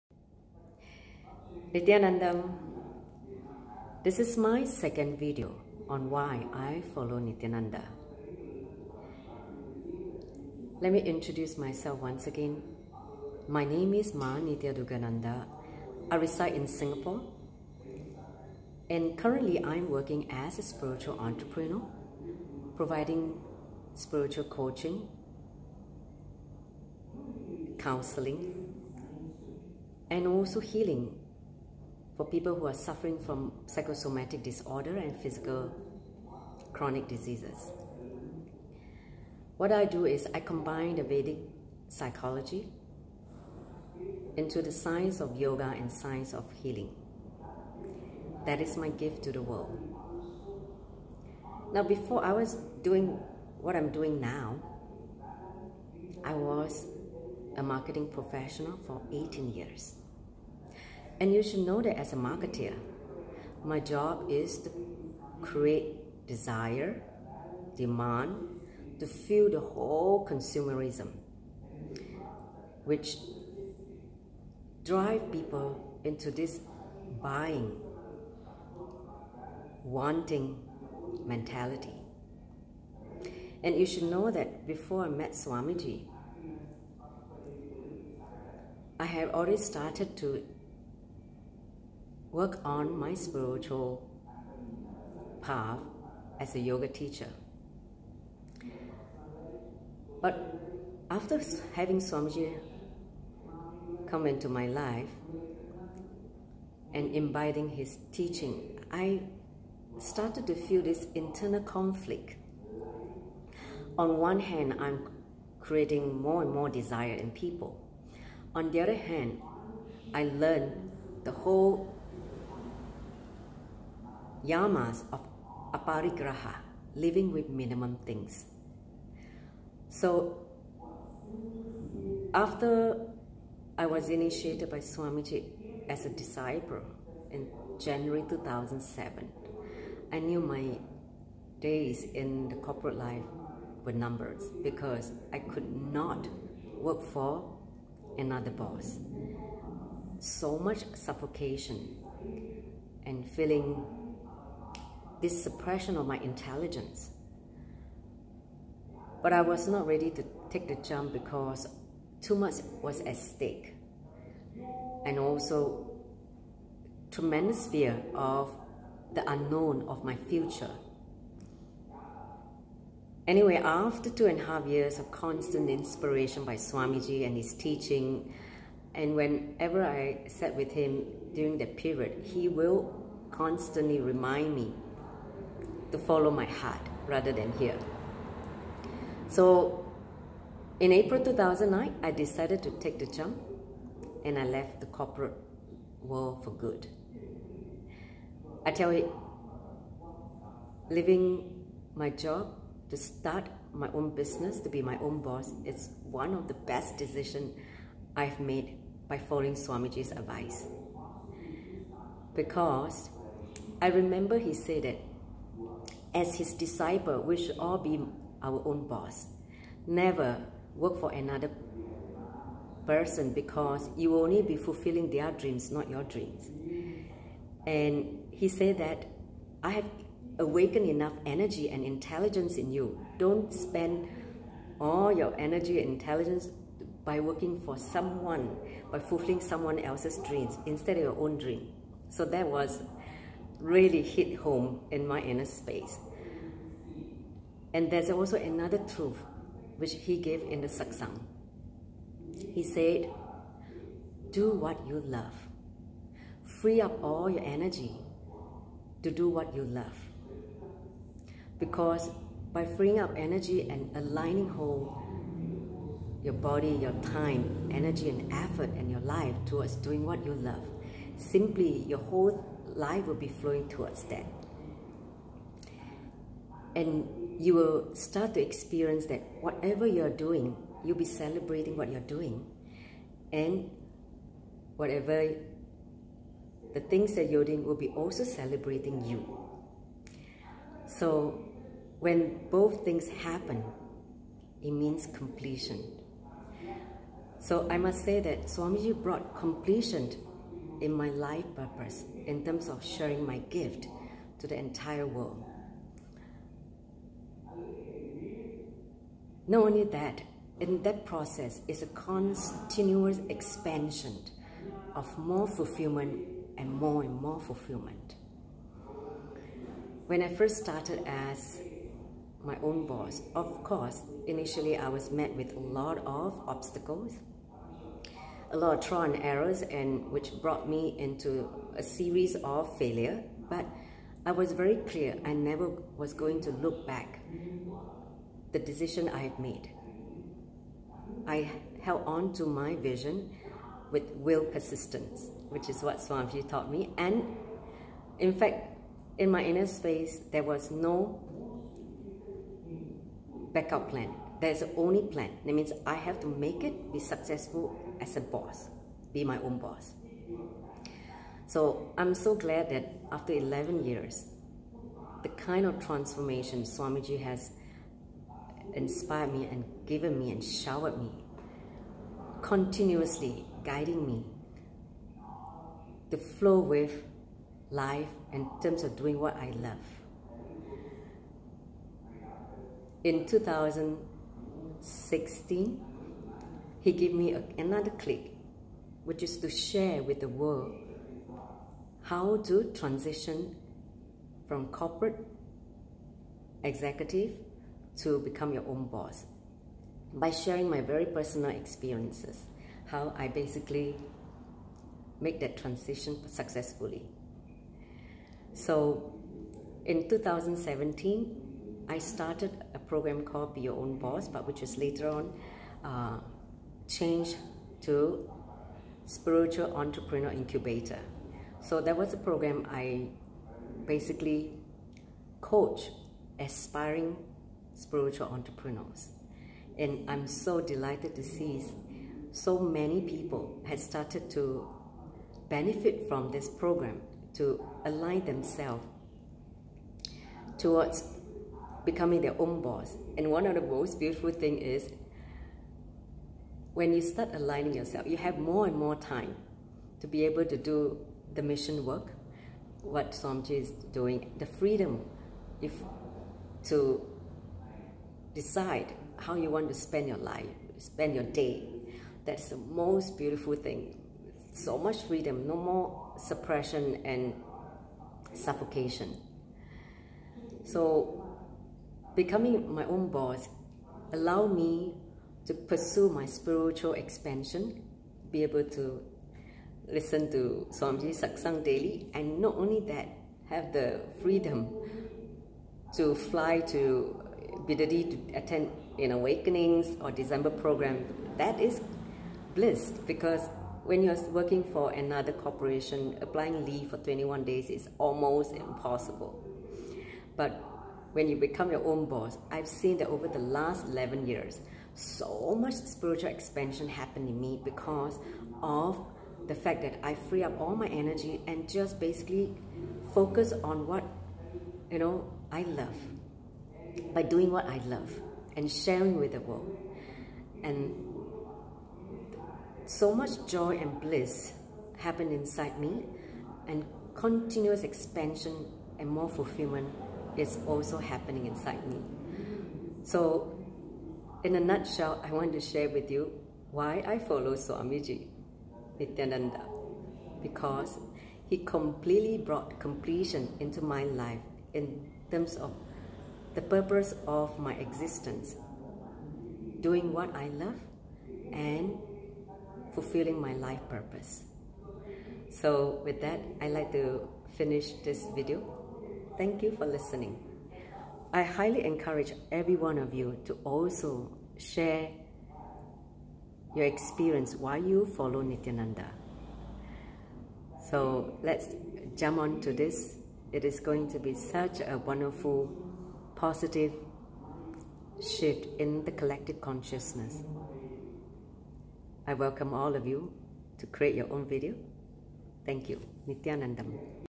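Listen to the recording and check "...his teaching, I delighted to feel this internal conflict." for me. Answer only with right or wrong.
wrong.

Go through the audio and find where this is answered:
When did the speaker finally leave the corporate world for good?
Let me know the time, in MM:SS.
03:10.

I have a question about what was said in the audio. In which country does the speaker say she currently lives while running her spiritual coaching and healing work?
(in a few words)
Singapore.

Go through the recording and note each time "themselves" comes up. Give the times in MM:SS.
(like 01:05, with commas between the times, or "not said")
07:18.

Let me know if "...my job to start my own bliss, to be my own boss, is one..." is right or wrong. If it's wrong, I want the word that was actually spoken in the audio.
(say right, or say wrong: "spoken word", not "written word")
wrong: "business", not "bliss".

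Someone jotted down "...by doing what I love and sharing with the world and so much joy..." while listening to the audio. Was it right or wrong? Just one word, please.
right.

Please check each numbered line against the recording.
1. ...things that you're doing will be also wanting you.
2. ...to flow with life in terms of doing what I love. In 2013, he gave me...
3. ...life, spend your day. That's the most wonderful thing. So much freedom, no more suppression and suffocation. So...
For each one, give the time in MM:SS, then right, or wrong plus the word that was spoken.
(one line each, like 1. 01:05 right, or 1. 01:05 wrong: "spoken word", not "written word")
1. 04:46 wrong: "celebrating", not "wanting"
2. 06:16 wrong: "2016", not "2013"
3. 07:40 wrong: "beautiful", not "wonderful".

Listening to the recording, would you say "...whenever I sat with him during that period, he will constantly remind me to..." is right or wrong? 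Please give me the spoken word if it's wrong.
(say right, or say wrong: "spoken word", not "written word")
right.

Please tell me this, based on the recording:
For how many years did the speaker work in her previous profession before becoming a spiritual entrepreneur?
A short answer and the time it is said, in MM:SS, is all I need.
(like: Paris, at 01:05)
18, at 00:59.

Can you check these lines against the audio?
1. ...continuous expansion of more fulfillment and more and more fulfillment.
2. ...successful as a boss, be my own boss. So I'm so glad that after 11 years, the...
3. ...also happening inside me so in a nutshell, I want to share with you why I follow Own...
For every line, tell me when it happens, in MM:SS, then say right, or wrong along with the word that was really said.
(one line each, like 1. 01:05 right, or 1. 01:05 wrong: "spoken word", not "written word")
1. 05:11 right
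2. 05:56 right
3. 08:50 wrong: "Swamiji", not "Own".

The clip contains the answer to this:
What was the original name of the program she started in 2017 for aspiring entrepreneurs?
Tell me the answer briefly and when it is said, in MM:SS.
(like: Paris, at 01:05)
Be Your Own Boss, at 06:53.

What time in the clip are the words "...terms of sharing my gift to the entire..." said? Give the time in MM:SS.
05:02.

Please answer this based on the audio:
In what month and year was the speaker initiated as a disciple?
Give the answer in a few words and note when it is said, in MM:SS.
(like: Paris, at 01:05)
January 2007, at 02:17.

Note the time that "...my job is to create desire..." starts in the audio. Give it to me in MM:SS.
01:03.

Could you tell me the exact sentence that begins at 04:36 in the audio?
And you will start to experience that whatever you're doing, you'll be celebrating what you're doing.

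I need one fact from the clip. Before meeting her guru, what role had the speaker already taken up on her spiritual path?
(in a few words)
Yoga teacher.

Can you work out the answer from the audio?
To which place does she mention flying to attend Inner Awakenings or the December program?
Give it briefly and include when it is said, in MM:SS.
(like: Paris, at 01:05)
Bidadi, at 08:07.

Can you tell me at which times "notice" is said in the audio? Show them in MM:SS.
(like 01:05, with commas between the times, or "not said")
not said.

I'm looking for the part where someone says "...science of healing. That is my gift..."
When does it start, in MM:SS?
00:45.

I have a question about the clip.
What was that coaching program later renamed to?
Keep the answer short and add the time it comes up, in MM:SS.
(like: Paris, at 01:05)
Spiritual Entrepreneur Incubator, at 06:59.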